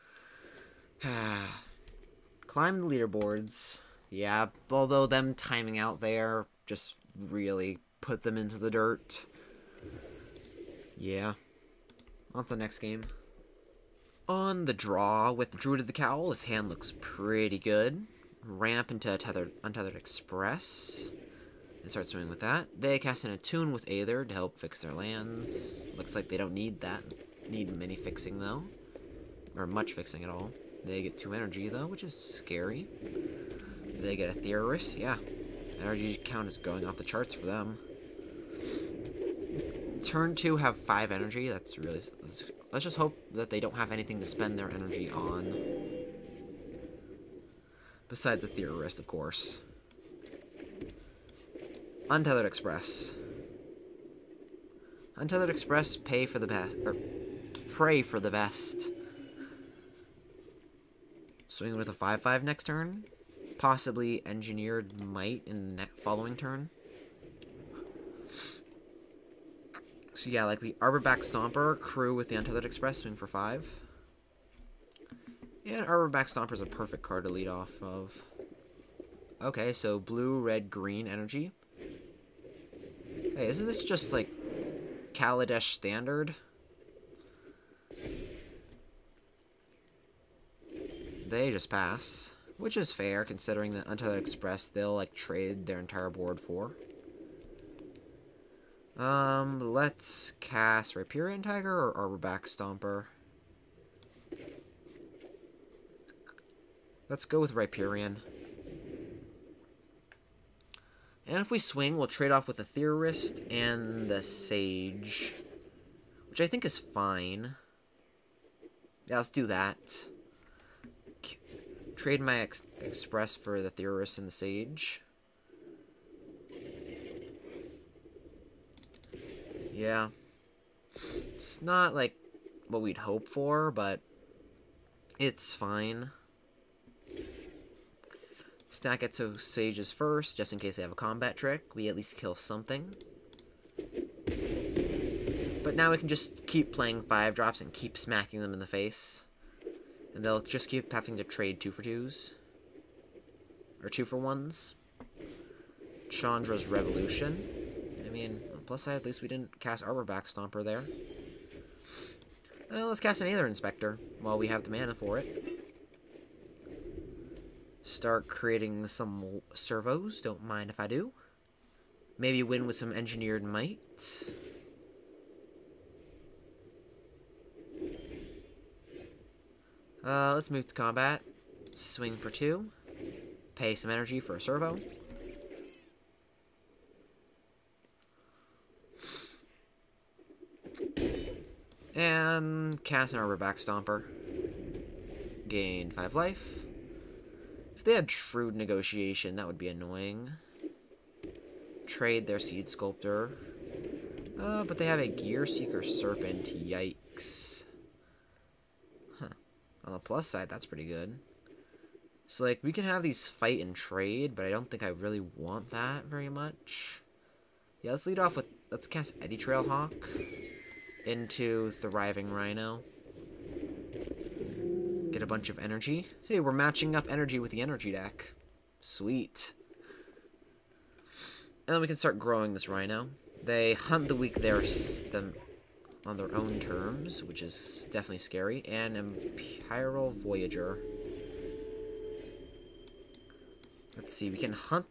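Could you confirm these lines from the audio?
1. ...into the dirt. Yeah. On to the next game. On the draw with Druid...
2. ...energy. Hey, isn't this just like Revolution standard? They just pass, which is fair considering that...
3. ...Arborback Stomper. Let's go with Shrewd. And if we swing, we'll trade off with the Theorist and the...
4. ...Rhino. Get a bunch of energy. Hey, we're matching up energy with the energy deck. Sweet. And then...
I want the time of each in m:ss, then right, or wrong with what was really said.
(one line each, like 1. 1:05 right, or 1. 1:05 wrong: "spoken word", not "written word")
1. 0:08 right
2. 1:21 wrong: "Kaladesh", not "Revolution"
3. 1:41 wrong: "Riparian", not "Shrewd"
4. 3:42 right.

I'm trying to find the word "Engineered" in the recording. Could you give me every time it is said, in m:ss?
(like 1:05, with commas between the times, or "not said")
1:04, 2:52.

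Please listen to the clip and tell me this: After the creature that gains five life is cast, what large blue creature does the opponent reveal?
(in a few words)
Gearseeker Serpent.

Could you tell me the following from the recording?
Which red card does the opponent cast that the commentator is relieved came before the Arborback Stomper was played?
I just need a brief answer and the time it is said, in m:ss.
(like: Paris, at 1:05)
Chandra's Revolution, at 2:36.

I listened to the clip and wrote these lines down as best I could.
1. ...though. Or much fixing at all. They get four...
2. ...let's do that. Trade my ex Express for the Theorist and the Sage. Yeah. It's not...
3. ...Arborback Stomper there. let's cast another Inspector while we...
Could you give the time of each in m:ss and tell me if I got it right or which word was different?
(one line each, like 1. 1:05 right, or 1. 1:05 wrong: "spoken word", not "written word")
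1. 0:28 wrong: "two", not "four"
2. 1:59 right
3. 2:39 right.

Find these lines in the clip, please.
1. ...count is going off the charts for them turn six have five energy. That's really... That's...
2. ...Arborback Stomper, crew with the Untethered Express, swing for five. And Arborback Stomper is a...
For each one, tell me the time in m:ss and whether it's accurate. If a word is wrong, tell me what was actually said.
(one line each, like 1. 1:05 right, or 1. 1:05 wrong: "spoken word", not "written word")
1. 0:36 wrong: "two", not "six"
2. 1:10 right.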